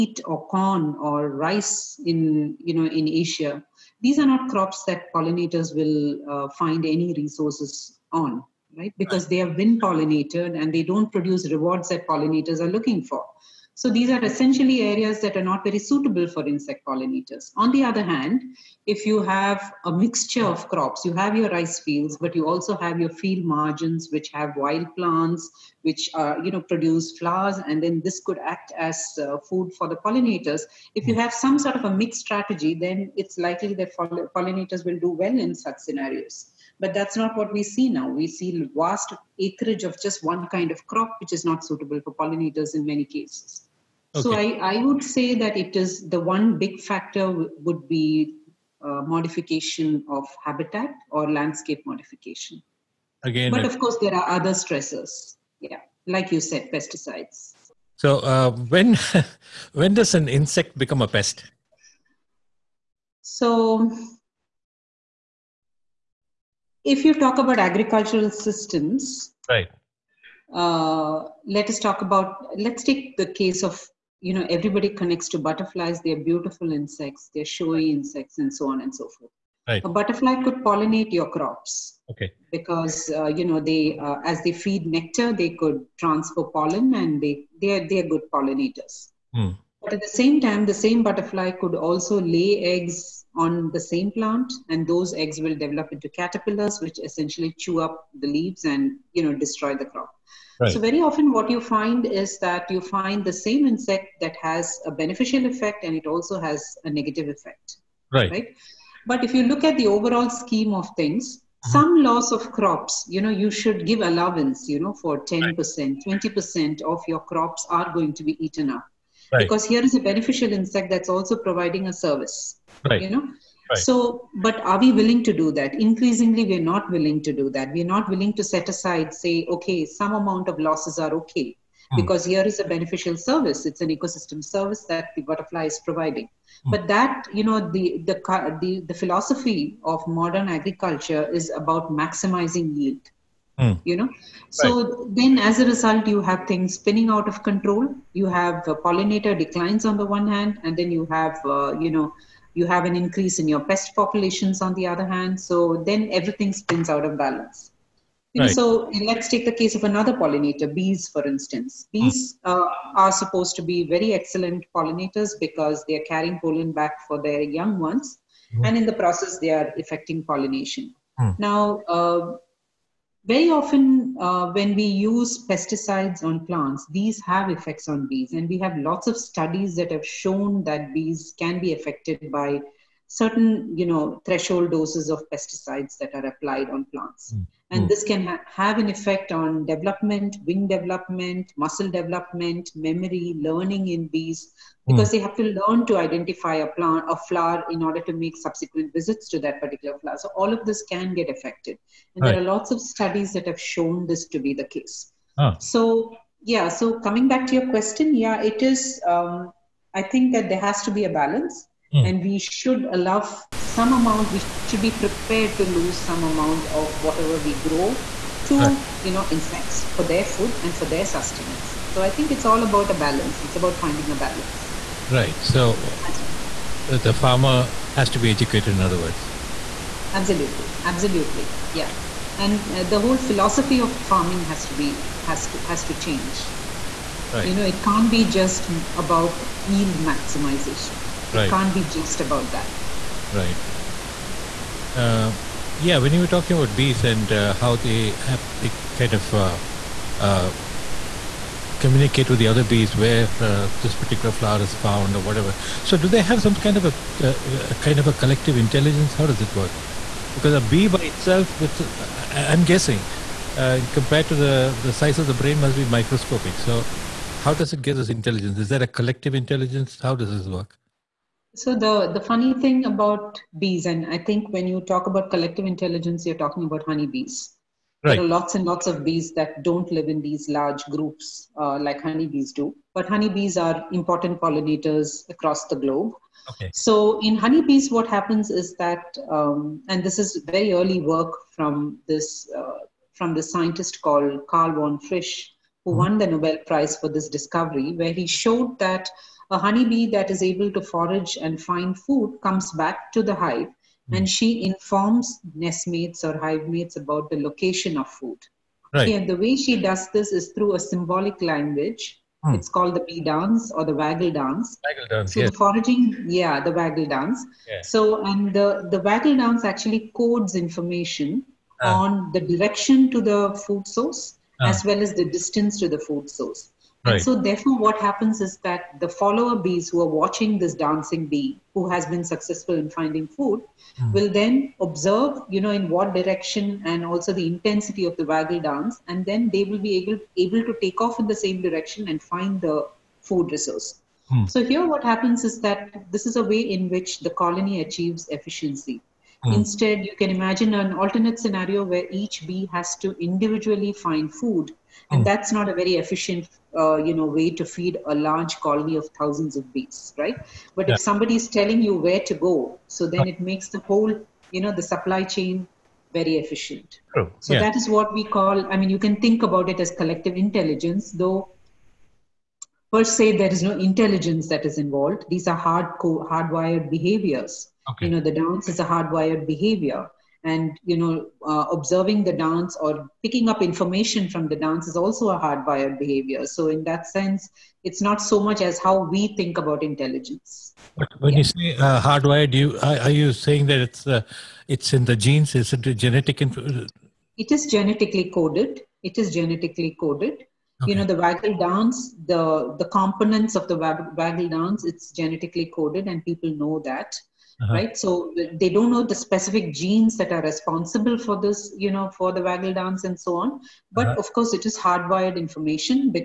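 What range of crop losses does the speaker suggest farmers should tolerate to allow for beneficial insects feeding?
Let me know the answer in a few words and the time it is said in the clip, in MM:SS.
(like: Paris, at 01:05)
10% to 20%, at 01:55.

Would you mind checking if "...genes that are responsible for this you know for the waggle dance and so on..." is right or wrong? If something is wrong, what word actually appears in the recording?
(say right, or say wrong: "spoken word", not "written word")
right.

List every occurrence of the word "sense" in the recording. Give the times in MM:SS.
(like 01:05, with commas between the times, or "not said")
06:27.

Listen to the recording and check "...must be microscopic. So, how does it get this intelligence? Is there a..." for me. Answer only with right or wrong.
right.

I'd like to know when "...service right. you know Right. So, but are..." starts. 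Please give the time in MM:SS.
02:01.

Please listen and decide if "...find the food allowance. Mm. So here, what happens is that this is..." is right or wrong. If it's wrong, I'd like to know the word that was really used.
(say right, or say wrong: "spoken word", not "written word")
wrong: "resource", not "allowance".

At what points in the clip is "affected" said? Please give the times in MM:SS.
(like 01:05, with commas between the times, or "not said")
03:01, 03:21.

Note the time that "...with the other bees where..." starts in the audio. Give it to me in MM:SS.
04:12.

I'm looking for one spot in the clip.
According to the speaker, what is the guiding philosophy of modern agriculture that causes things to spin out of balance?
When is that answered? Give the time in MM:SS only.
02:21.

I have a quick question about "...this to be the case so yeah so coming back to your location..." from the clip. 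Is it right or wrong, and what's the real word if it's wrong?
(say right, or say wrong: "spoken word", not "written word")
wrong: "question", not "location".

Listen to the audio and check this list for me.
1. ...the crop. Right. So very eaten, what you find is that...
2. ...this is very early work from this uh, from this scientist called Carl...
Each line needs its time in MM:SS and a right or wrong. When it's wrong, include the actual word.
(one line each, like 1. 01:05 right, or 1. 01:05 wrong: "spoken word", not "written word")
1. 01:39 wrong: "often", not "eaten"
2. 04:50 right.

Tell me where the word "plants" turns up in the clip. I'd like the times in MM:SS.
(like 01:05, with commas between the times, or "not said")
00:24, 01:34, 02:56, 03:06, 03:16.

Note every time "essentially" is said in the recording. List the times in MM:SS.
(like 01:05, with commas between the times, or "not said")
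00:14, 01:37.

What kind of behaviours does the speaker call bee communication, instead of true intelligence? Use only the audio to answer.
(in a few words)
hardwired behaviors.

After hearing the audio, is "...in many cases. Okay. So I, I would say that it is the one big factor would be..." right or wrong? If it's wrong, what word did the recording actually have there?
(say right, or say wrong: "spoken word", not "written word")
right.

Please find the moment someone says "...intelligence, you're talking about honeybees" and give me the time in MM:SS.
04:35.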